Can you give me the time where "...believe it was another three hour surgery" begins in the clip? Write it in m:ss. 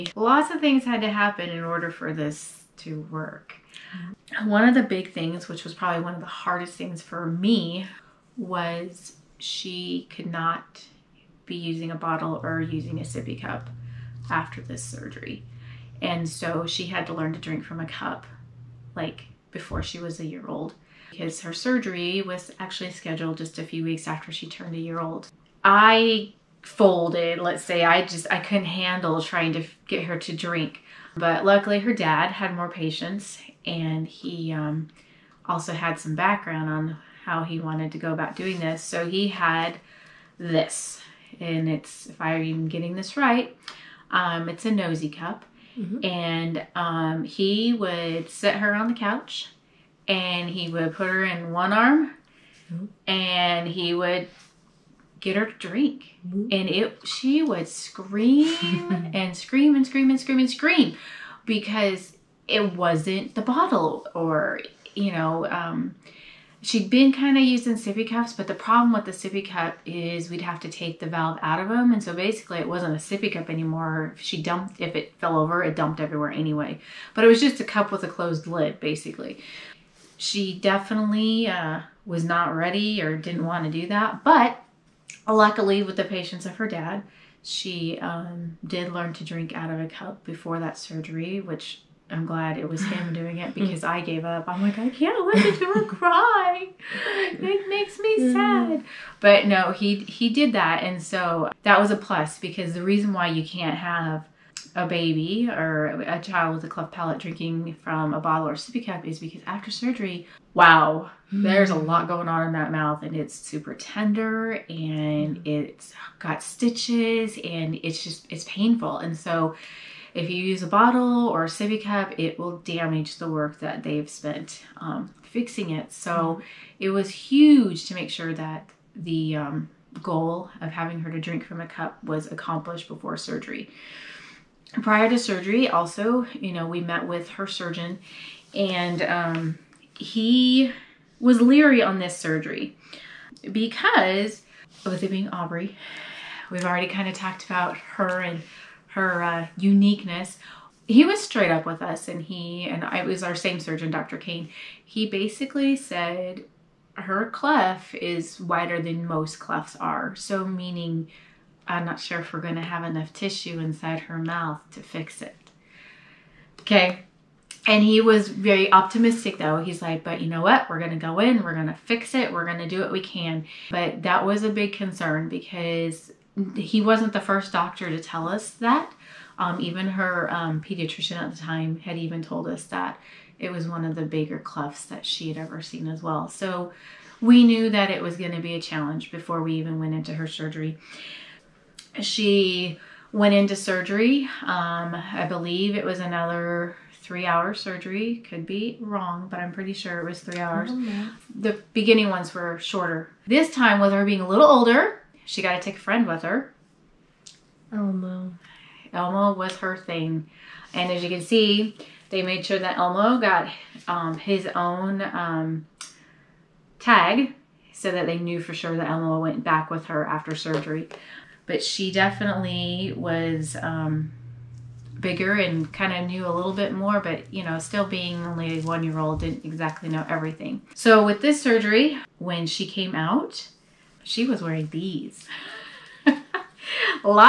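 3:15.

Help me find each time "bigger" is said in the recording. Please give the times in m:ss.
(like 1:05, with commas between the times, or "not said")
3:04, 3:44.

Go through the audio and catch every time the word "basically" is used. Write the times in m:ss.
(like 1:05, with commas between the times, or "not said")
1:12, 1:18, 2:35.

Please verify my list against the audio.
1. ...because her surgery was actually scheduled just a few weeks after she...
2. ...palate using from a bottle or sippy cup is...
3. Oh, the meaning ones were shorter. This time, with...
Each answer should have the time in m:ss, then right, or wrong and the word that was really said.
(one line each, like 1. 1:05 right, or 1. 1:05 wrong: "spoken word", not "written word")
1. 0:21 right
2. 1:46 wrong: "drinking", not "using"
3. 3:20 wrong: "beginning", not "meaning".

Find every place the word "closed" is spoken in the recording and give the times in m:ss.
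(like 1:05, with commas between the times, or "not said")
1:18.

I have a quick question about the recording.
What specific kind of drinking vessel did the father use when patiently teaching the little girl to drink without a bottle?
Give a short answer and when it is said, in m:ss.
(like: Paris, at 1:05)
nosy cup, at 0:44.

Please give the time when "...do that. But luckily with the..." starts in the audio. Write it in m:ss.
1:23.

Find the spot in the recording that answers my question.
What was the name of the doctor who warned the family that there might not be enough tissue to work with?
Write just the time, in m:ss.
2:33.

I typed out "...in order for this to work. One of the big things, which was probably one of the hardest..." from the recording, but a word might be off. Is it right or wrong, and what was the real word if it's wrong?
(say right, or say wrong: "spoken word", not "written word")
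right.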